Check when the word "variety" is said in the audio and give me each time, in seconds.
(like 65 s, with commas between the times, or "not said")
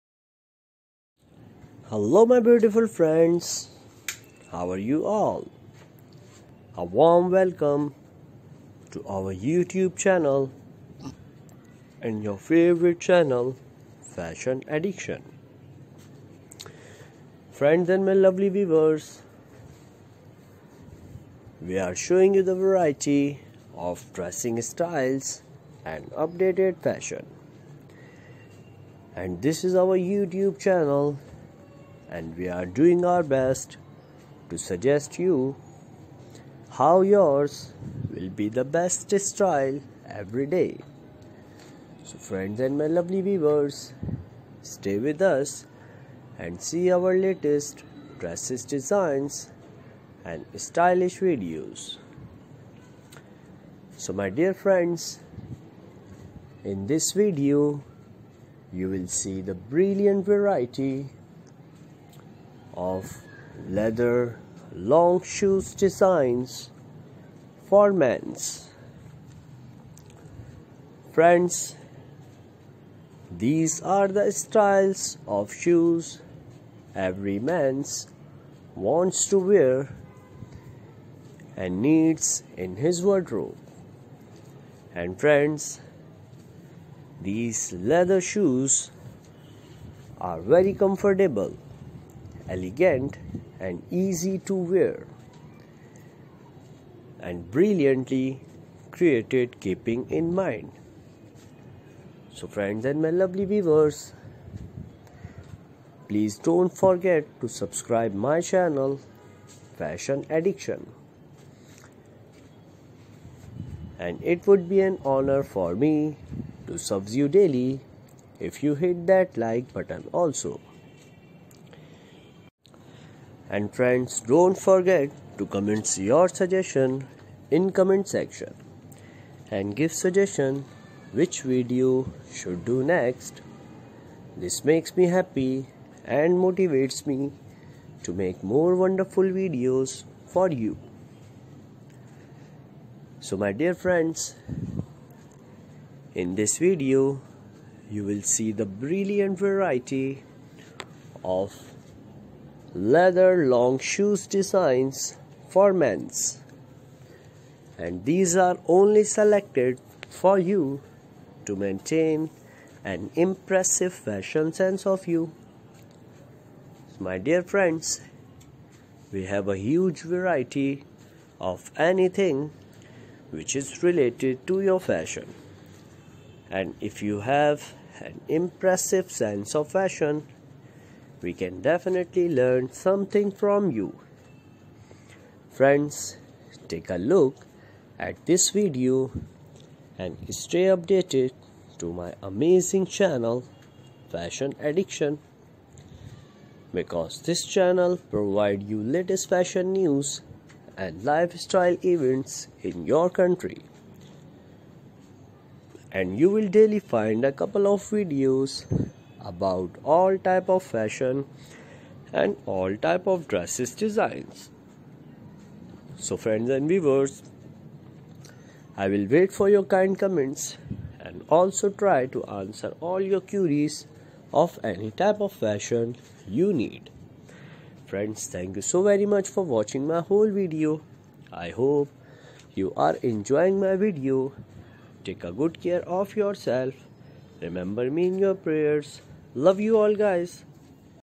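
22 s, 60 s, 149 s, 170 s.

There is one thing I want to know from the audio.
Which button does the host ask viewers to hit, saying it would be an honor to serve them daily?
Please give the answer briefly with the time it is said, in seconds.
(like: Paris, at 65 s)
like button, at 119 s.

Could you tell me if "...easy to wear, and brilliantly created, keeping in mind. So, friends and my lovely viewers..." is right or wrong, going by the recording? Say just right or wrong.
right.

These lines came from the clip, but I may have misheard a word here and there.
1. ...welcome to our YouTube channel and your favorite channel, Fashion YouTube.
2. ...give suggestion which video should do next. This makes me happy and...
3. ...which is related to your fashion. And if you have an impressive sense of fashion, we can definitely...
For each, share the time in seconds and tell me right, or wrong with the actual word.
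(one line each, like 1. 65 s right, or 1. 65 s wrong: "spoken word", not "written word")
1. 7 s wrong: "Addiction", not "YouTube"
2. 129 s right
3. 173 s right.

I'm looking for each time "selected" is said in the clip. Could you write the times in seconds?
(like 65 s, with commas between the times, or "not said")
159 s.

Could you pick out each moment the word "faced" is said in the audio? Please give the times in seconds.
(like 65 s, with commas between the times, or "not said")
not said.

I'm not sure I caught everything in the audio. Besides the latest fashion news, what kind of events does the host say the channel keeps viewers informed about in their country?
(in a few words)
lifestyle events.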